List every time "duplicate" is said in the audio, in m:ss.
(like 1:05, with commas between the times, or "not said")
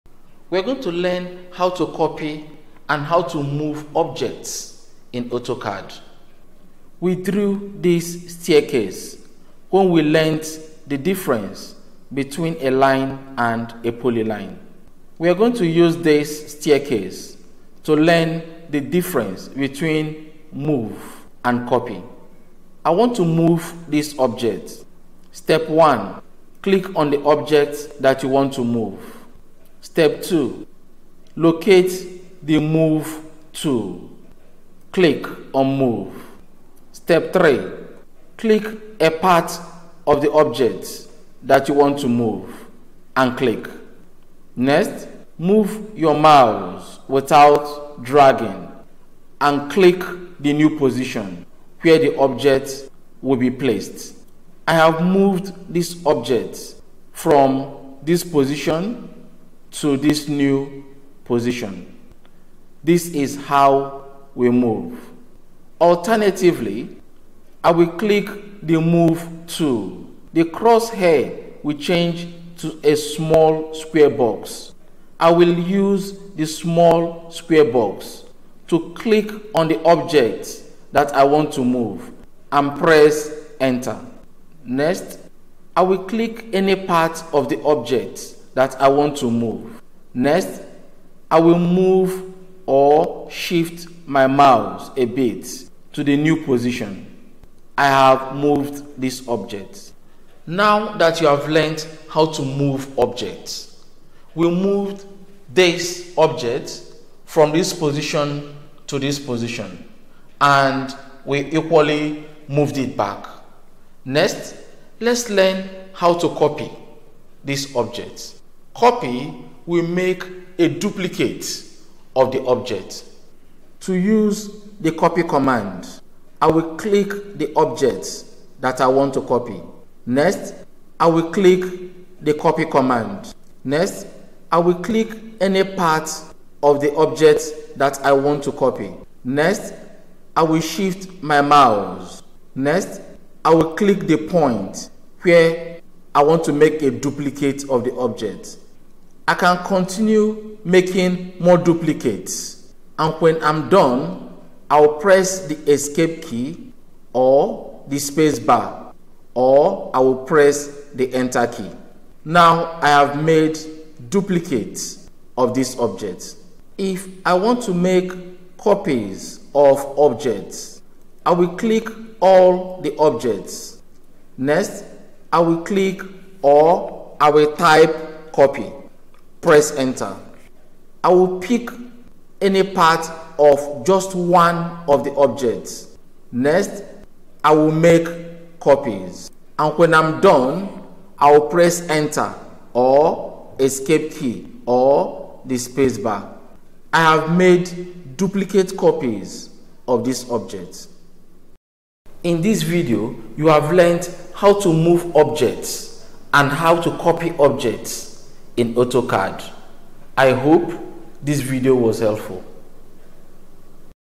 2:00, 2:26, 2:31, 2:44, 3:18.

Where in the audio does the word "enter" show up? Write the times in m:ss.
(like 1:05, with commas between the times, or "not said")
1:23, 2:41, 2:59, 3:11.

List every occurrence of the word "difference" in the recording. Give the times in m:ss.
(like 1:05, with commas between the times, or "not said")
0:10, 0:18.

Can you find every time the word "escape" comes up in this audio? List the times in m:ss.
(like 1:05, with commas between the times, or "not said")
2:35, 3:13.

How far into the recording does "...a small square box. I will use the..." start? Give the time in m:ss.
1:12.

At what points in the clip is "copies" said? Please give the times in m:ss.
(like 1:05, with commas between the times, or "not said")
2:48, 3:08, 3:18.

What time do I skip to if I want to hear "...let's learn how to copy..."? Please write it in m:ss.
1:54.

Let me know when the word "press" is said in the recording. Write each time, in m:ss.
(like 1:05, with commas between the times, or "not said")
1:22, 2:34, 2:40, 2:59, 3:11.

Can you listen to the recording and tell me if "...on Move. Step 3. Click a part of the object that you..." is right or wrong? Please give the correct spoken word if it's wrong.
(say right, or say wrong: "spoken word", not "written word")
right.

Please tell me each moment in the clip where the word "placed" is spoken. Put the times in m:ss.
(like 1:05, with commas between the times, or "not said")
0:53.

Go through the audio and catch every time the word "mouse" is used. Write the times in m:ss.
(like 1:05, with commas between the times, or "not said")
0:46, 1:34, 2:21.